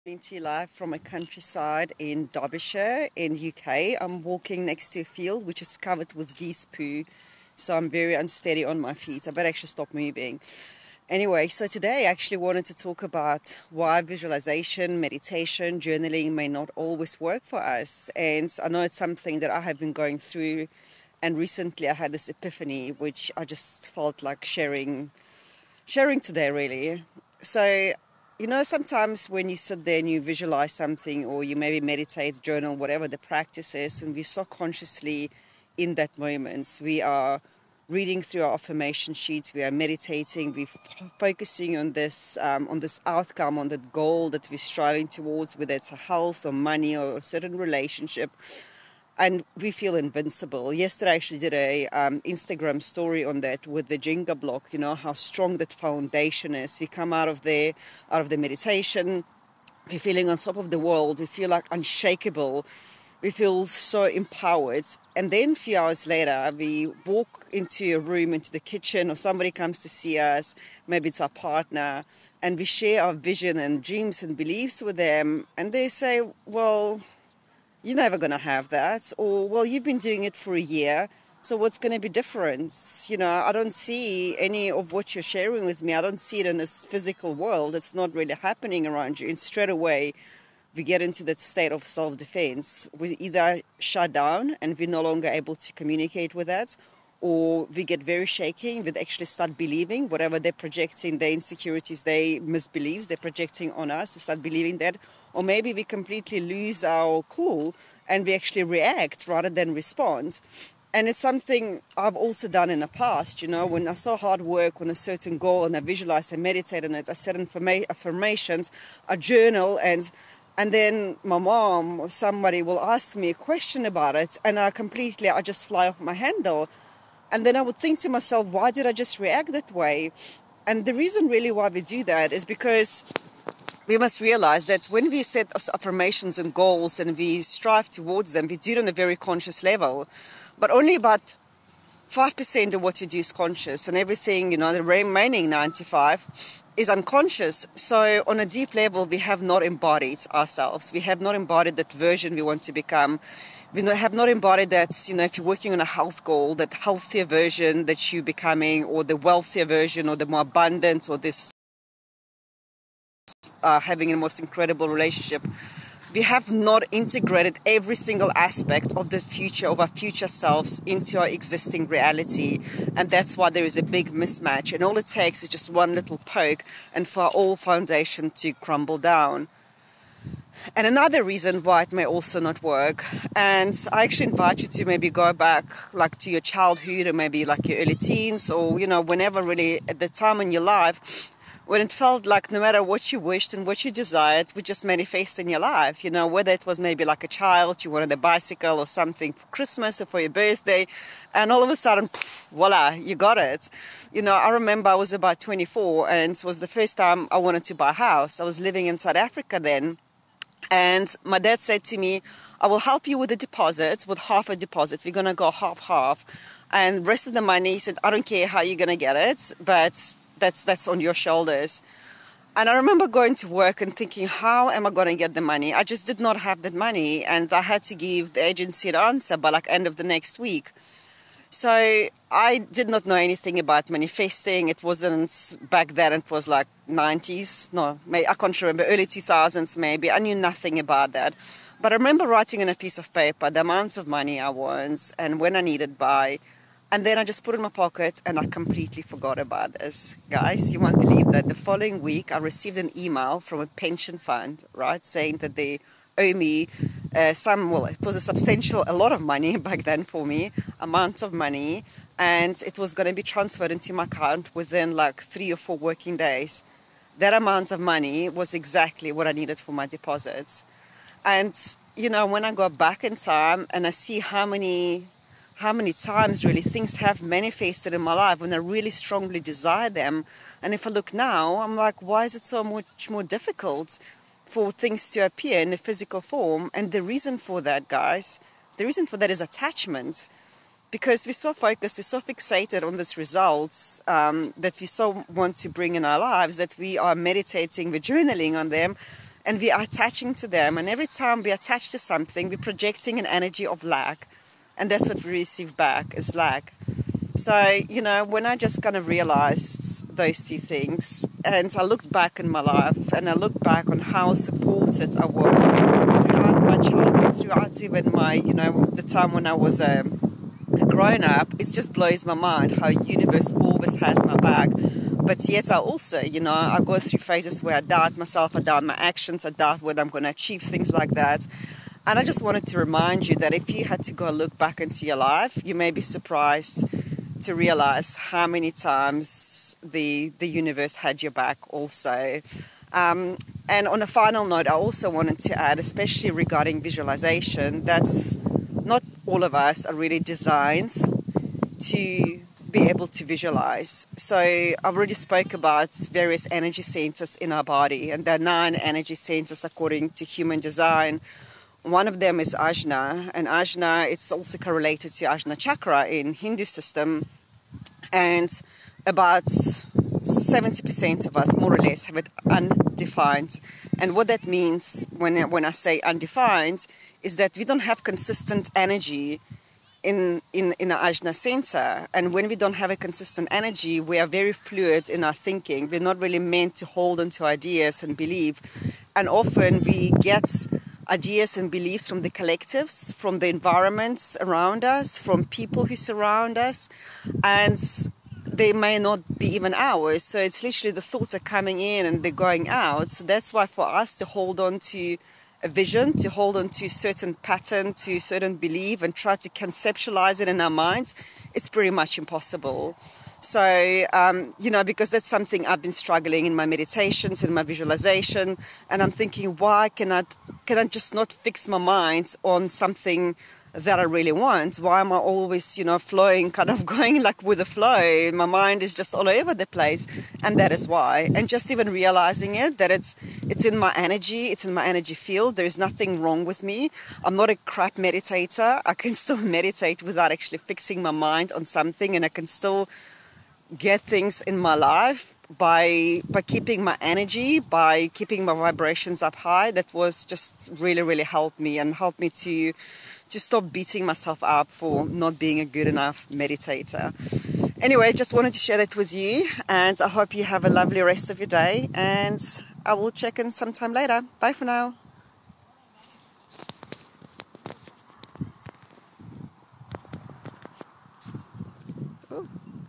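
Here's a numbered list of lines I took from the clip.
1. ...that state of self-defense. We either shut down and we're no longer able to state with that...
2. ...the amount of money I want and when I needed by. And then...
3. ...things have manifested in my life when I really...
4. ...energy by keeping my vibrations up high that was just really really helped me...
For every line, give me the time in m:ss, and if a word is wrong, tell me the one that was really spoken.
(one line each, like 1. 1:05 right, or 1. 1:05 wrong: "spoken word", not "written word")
1. 1:31 wrong: "communicate", not "state"
2. 4:03 right
3. 4:36 right
4. 7:26 right.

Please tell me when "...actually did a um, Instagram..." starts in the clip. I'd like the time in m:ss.
0:51.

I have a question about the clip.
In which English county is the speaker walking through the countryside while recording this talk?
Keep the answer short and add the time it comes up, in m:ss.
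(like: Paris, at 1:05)
Derbyshire, at 0:02.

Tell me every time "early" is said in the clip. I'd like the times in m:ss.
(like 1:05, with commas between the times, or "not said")
3:07, 3:58.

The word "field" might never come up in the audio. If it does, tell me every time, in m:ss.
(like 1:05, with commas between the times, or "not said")
0:05, 7:15.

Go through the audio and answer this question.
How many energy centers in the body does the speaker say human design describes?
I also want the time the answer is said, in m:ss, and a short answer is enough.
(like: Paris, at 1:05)
9, at 5:58.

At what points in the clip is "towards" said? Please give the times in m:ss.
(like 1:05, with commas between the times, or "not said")
0:45, 2:17.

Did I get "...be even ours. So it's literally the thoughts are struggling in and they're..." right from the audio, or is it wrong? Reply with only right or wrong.
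wrong.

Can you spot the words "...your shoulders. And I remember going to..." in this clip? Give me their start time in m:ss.
3:40.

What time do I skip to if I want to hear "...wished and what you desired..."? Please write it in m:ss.
3:13.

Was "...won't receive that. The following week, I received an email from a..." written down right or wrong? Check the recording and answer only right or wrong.
wrong.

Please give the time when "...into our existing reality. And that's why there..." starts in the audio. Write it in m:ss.
2:50.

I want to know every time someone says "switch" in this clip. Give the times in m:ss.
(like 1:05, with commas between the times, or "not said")
not said.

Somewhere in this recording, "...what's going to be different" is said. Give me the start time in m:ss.
1:21.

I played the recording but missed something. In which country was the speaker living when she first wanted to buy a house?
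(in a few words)
South Africa.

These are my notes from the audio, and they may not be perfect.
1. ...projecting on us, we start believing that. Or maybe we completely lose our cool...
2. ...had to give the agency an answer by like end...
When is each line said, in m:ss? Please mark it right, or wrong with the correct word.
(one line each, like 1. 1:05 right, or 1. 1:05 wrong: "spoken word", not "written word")
1. 1:43 right
2. 3:47 right.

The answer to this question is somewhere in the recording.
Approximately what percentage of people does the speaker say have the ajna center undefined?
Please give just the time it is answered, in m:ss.
6:09.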